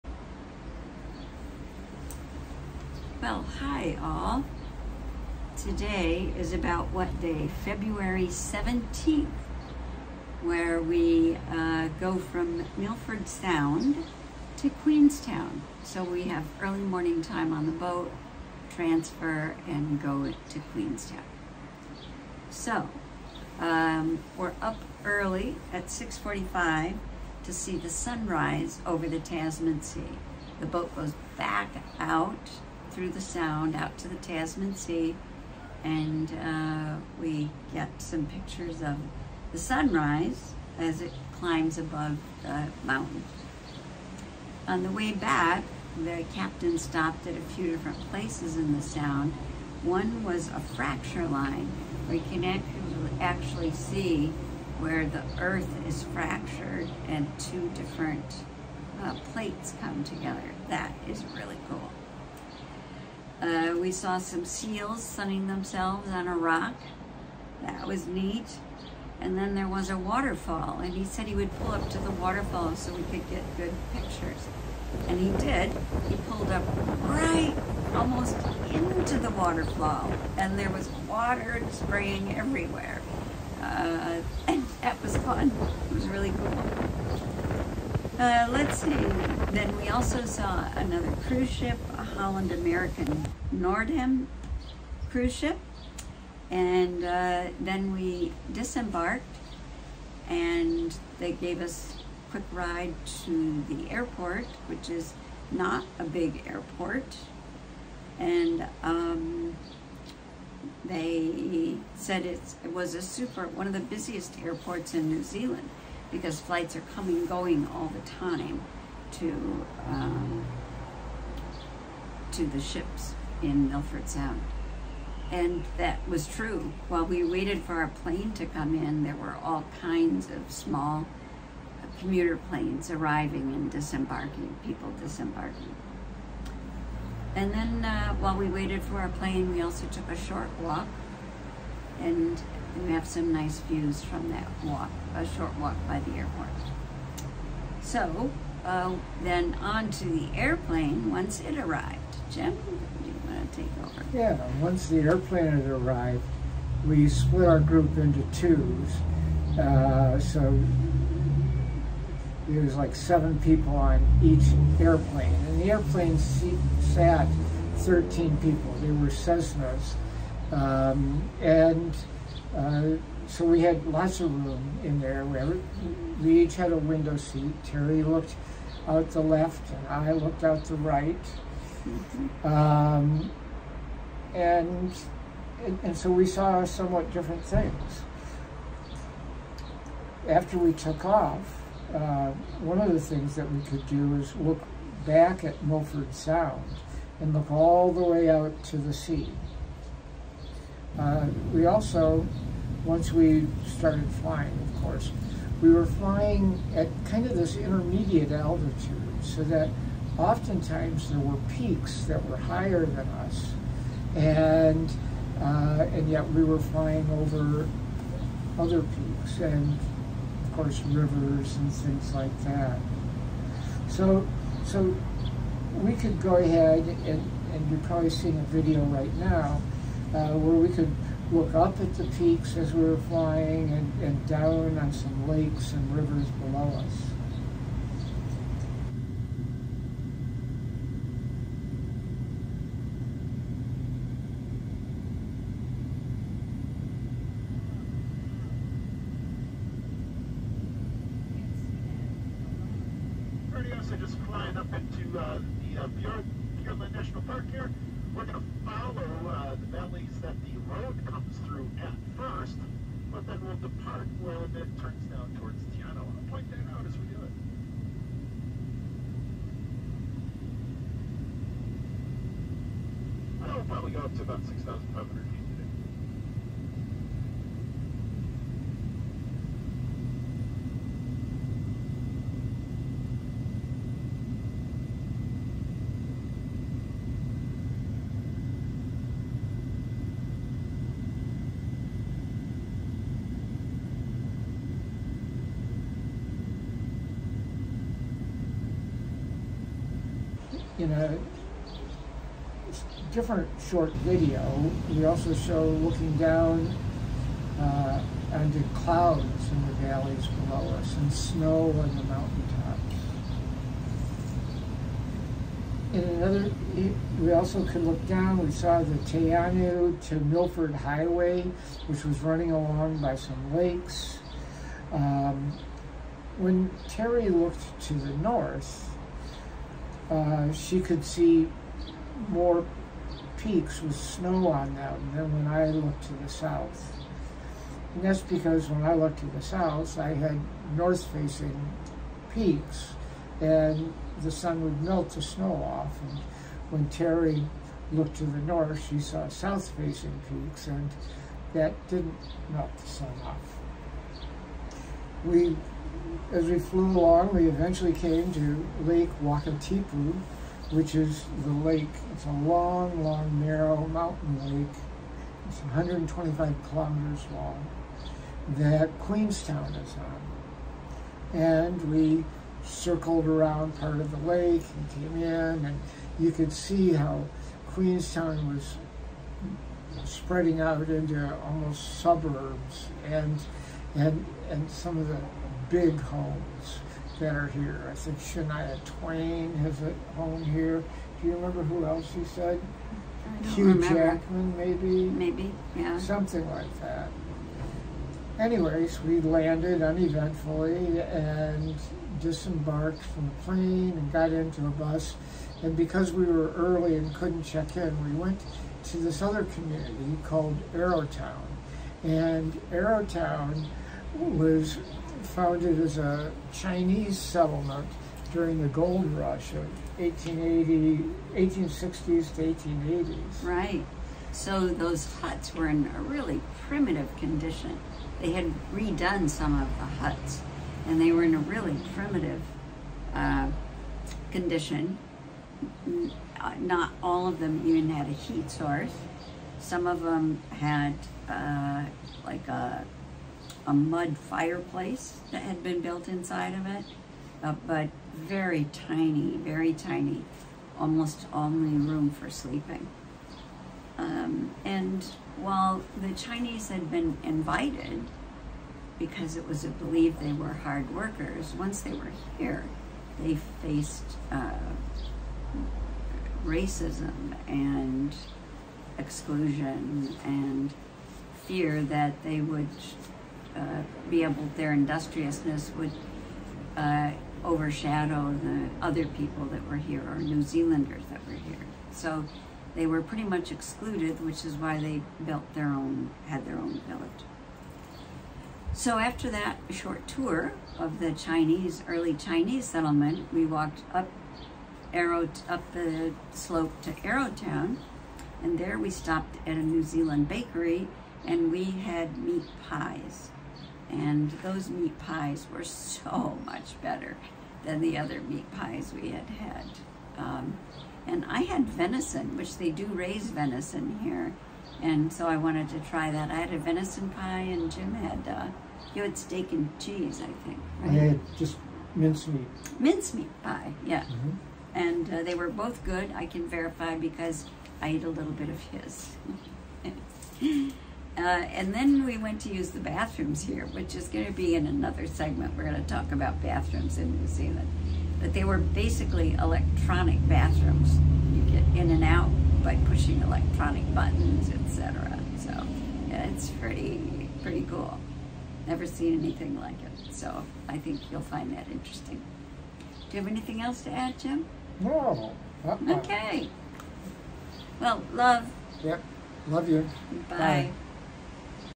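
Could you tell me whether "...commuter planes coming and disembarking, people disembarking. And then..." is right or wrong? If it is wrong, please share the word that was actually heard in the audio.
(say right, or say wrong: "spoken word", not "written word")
wrong: "arriving", not "coming".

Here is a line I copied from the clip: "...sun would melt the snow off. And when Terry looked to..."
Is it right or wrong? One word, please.
right.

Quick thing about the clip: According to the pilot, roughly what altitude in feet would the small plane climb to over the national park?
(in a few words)
6,500 feet.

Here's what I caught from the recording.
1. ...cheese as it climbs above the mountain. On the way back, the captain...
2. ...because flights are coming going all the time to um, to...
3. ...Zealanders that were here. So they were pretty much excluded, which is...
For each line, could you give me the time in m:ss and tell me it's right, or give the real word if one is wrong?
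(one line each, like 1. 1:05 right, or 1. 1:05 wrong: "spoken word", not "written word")
1. 0:39 wrong: "sunrise", not "cheese"
2. 1:56 right
3. 8:00 right.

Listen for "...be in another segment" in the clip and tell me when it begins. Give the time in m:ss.
8:54.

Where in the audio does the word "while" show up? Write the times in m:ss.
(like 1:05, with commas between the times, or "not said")
2:06, 2:18, 7:35.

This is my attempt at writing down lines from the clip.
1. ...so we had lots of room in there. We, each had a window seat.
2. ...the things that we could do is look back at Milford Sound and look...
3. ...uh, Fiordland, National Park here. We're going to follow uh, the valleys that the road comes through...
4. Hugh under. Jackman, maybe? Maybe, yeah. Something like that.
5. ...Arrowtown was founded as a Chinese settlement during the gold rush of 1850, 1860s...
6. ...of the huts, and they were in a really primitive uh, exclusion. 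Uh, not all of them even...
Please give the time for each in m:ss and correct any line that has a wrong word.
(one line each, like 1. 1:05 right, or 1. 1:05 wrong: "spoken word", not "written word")
1. 2:53 right
2. 3:12 right
3. 4:15 right
4. 6:33 wrong: "remember", not "under"
5. 6:52 wrong: "1880", not "1850"
6. 7:09 wrong: "condition", not "exclusion".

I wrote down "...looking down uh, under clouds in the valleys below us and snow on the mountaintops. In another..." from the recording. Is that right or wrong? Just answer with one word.
right.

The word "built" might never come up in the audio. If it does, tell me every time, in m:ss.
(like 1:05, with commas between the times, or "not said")
7:25, 8:05.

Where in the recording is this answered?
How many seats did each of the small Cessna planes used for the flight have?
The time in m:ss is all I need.
2:47.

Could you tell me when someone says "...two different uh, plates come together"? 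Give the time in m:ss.
0:57.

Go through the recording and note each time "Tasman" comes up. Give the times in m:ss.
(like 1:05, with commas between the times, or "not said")
0:29, 0:34.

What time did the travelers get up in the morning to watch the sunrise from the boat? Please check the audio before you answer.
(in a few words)
6:45.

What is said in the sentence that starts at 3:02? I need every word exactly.
Um, and, and so we saw somewhat different things.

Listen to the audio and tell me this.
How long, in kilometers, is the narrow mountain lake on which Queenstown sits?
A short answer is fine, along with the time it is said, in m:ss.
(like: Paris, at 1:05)
125 kilometers, at 6:05.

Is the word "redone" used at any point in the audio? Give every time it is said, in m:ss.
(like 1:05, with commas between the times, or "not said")
7:08.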